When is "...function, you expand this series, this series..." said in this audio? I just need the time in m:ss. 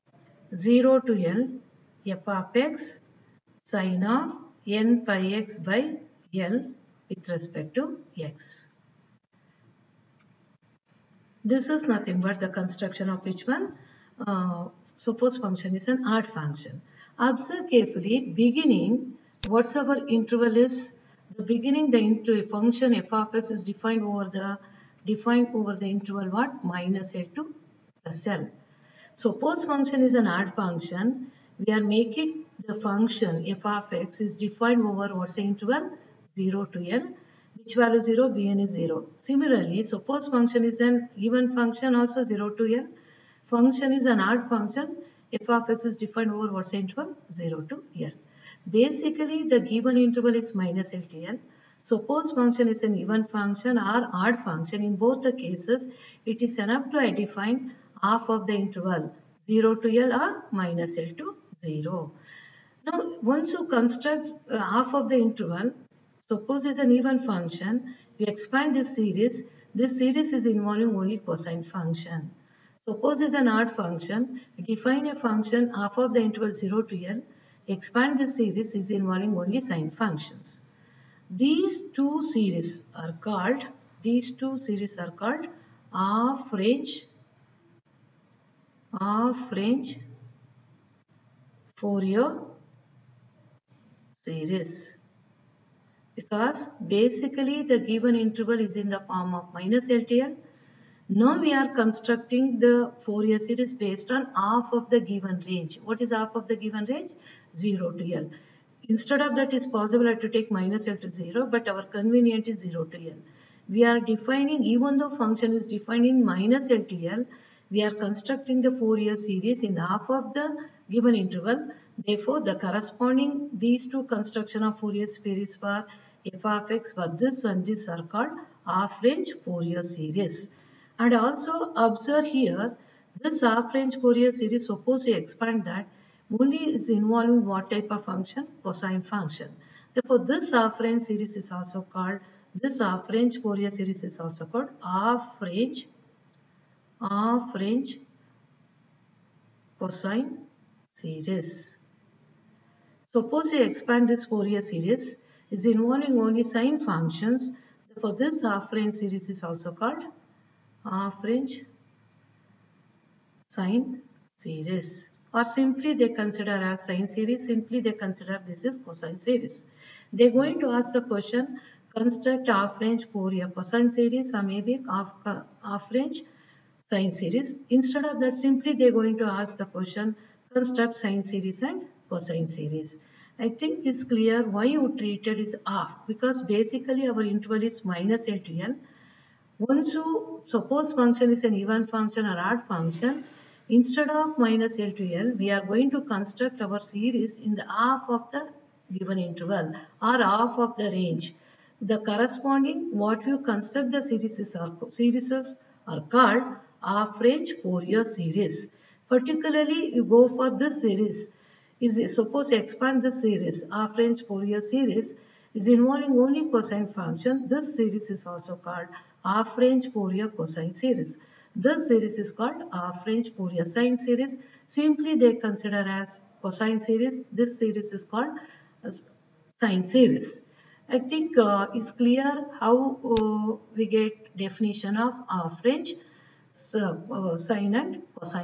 1:07.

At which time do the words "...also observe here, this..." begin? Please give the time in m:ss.
2:11.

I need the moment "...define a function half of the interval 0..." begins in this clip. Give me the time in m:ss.
1:14.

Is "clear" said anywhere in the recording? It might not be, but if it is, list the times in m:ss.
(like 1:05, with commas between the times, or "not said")
3:04, 3:51.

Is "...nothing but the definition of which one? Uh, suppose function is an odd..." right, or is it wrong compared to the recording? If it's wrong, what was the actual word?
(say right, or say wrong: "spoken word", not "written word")
wrong: "construction", not "definition".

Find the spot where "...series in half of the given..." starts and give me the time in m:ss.
1:59.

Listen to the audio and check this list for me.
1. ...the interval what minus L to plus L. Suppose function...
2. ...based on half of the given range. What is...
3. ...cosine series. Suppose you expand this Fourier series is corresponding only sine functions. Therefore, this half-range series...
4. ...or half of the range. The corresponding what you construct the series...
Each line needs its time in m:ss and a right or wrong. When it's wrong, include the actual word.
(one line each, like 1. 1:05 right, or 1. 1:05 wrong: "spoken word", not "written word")
1. 0:25 right
2. 1:43 right
3. 2:29 wrong: "involving", not "corresponding"
4. 3:20 right.